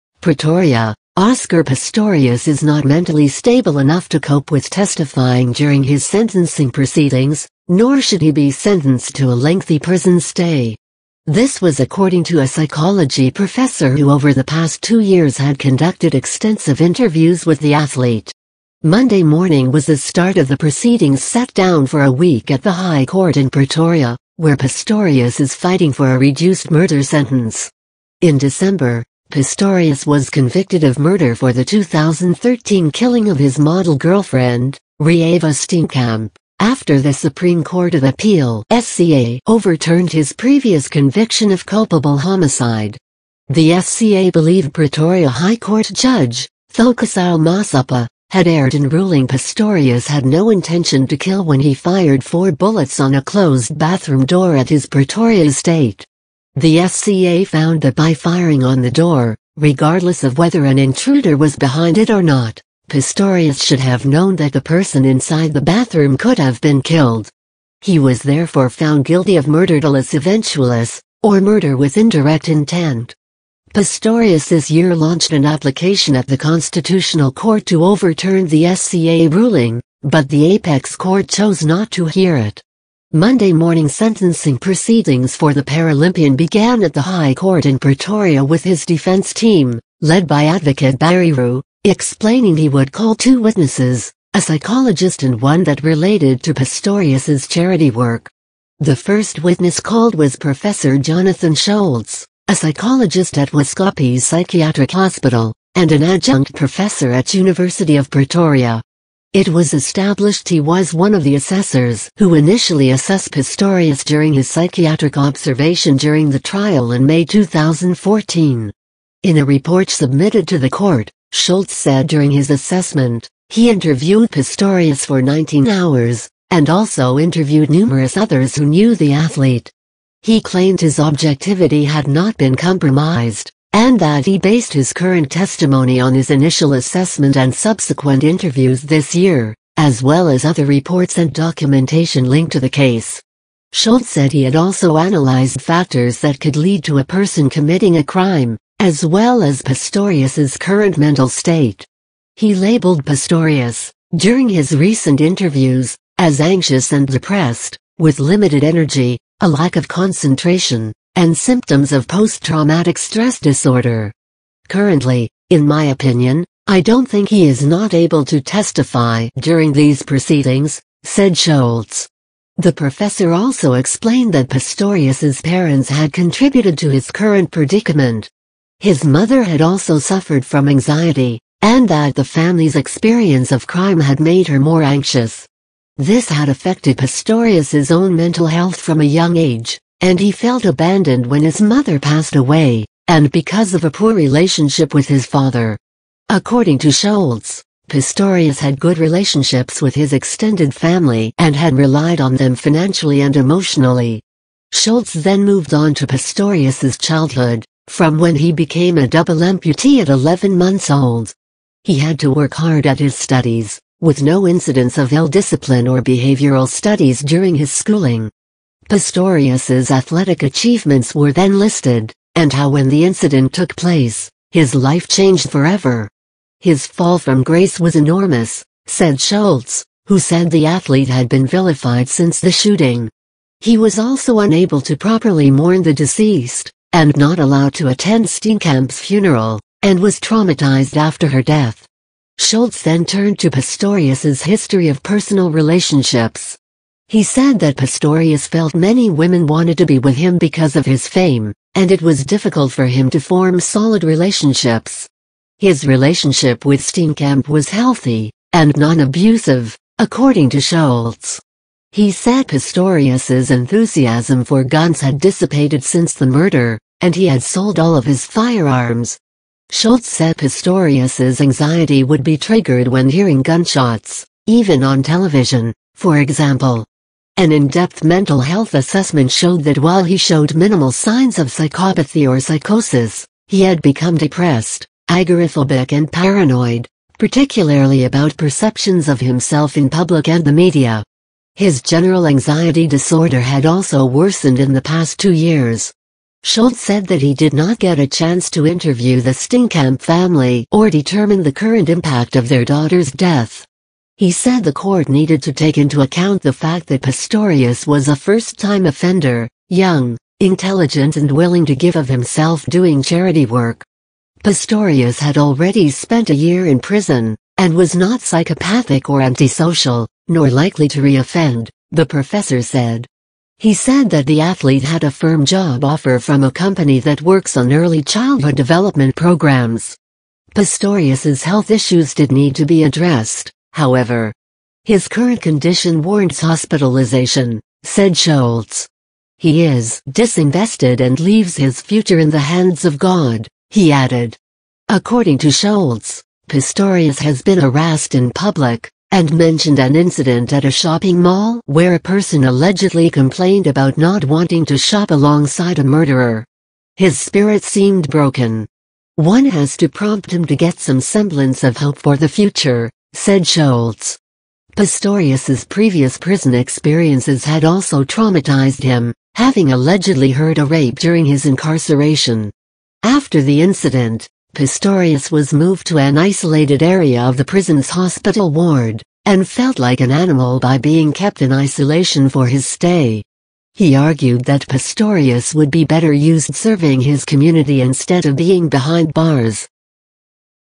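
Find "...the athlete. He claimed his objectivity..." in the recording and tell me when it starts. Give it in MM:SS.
02:08.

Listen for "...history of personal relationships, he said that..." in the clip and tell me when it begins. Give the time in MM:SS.
04:04.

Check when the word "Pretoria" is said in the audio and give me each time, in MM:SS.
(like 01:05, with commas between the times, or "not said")
00:00, 00:23, 00:44, 00:54, 01:27, 01:48.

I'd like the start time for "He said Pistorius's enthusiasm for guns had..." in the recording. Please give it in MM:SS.
04:21.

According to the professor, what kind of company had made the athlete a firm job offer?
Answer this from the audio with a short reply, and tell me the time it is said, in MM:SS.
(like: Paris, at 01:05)
early childhood development, at 05:27.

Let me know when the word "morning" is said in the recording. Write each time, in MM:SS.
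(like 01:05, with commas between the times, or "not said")
00:19, 01:23.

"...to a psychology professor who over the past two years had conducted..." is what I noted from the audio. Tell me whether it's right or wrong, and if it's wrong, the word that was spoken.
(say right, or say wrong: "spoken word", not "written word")
right.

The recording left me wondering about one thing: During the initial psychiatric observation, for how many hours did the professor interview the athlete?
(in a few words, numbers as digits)
19 hours.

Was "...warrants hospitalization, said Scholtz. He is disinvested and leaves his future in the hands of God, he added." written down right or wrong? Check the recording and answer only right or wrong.
right.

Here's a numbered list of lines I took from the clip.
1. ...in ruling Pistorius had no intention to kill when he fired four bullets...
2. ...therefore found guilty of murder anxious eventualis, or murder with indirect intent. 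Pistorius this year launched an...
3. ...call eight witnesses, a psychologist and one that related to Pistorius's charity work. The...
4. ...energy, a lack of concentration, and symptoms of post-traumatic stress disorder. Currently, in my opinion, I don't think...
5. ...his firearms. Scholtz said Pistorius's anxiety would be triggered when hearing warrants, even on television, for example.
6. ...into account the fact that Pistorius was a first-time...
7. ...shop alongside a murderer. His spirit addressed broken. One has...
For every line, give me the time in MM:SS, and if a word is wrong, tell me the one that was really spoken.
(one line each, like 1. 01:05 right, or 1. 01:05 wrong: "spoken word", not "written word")
1. 00:48 right
2. 01:08 wrong: "dolus", not "anxious"
3. 01:32 wrong: "two", not "eight"
4. 02:38 right
5. 04:28 wrong: "gunshots", not "warrants"
6. 05:05 right
7. 05:54 wrong: "seemed", not "addressed".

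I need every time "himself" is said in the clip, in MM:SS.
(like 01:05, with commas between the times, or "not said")
04:49, 05:12.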